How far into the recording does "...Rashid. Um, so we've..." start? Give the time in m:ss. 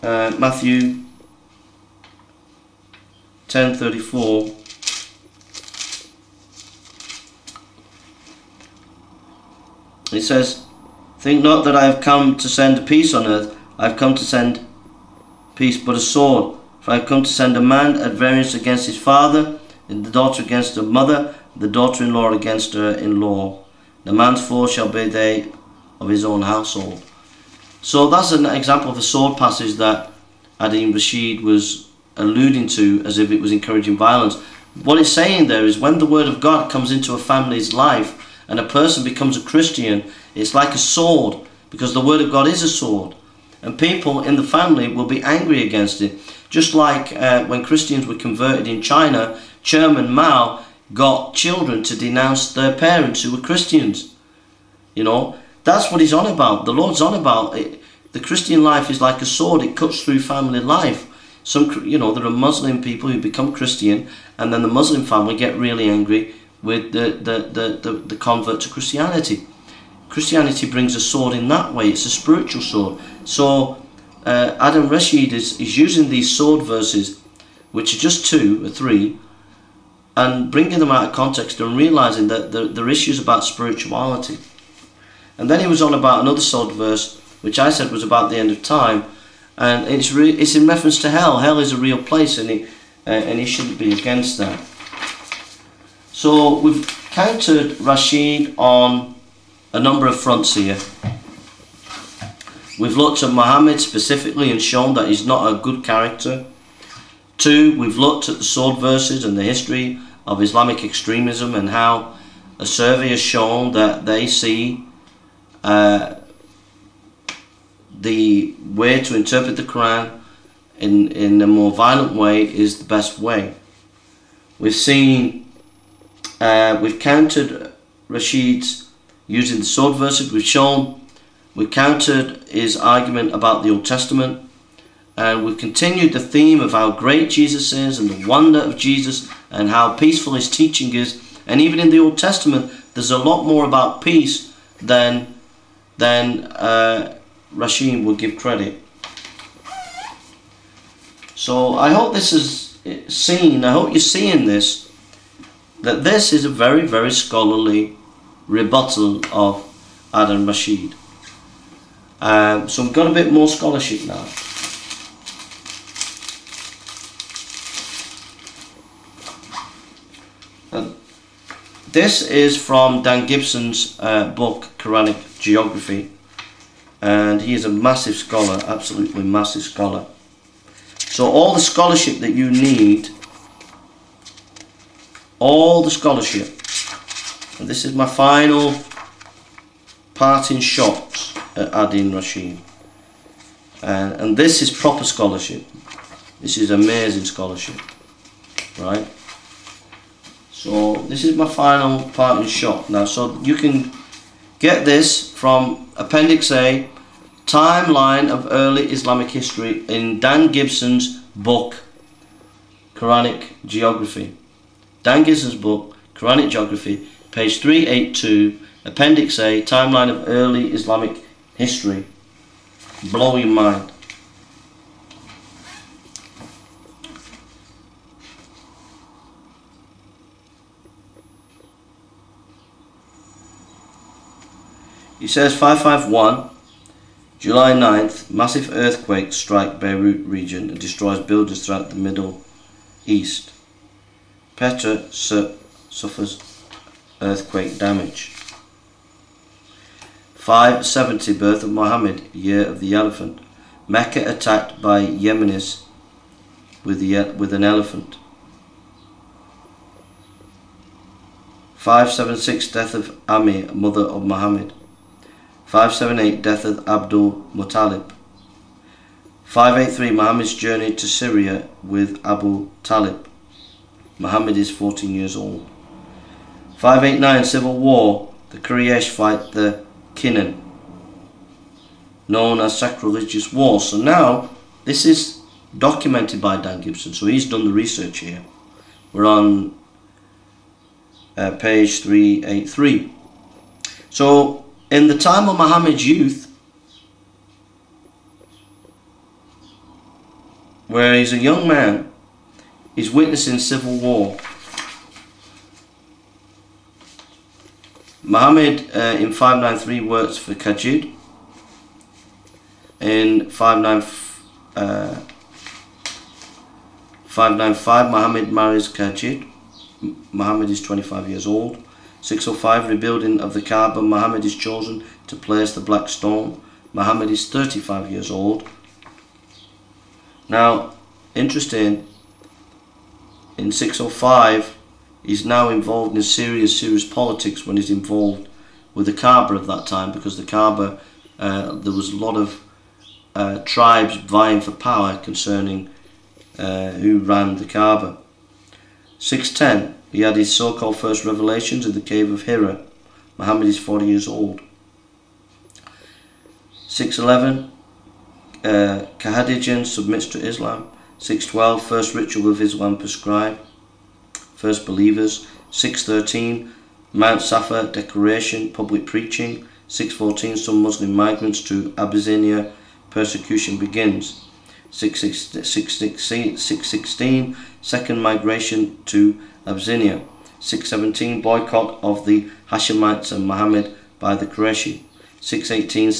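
2:40.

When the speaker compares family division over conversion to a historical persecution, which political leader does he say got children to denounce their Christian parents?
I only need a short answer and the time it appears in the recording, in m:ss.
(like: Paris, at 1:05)
Chairman Mao, at 0:49.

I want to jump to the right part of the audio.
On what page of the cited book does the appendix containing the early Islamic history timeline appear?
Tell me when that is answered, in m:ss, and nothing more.
3:37.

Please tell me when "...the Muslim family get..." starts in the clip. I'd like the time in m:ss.
1:04.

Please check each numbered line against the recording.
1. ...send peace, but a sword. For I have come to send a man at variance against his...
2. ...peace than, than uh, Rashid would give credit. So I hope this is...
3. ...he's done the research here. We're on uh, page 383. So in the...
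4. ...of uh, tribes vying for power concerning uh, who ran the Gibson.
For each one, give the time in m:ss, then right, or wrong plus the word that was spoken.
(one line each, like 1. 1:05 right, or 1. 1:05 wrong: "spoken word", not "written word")
1. 0:14 right
2. 2:24 right
3. 4:47 right
4. 5:42 wrong: "Kaaba", not "Gibson".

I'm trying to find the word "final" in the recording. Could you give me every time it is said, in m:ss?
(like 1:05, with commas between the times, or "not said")
3:08, 3:21.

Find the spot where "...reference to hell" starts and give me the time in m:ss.
1:30.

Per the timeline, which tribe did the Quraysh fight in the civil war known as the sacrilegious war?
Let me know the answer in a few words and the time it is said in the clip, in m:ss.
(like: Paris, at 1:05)
Kinnan, at 4:40.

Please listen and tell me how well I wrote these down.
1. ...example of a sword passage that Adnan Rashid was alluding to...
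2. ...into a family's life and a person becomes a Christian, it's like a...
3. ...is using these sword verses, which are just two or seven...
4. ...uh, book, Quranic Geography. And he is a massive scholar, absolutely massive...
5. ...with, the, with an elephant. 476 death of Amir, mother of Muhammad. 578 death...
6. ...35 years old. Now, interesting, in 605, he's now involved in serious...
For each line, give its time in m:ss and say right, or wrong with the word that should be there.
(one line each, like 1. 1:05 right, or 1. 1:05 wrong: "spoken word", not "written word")
1. 0:28 right
2. 0:36 right
3. 1:15 wrong: "three", not "seven"
4. 2:54 right
5. 4:16 wrong: "576", not "476"
6. 5:27 right.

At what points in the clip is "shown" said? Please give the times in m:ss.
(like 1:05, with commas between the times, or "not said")
1:44, 1:53, 2:10.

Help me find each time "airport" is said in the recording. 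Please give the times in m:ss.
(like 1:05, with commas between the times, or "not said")
not said.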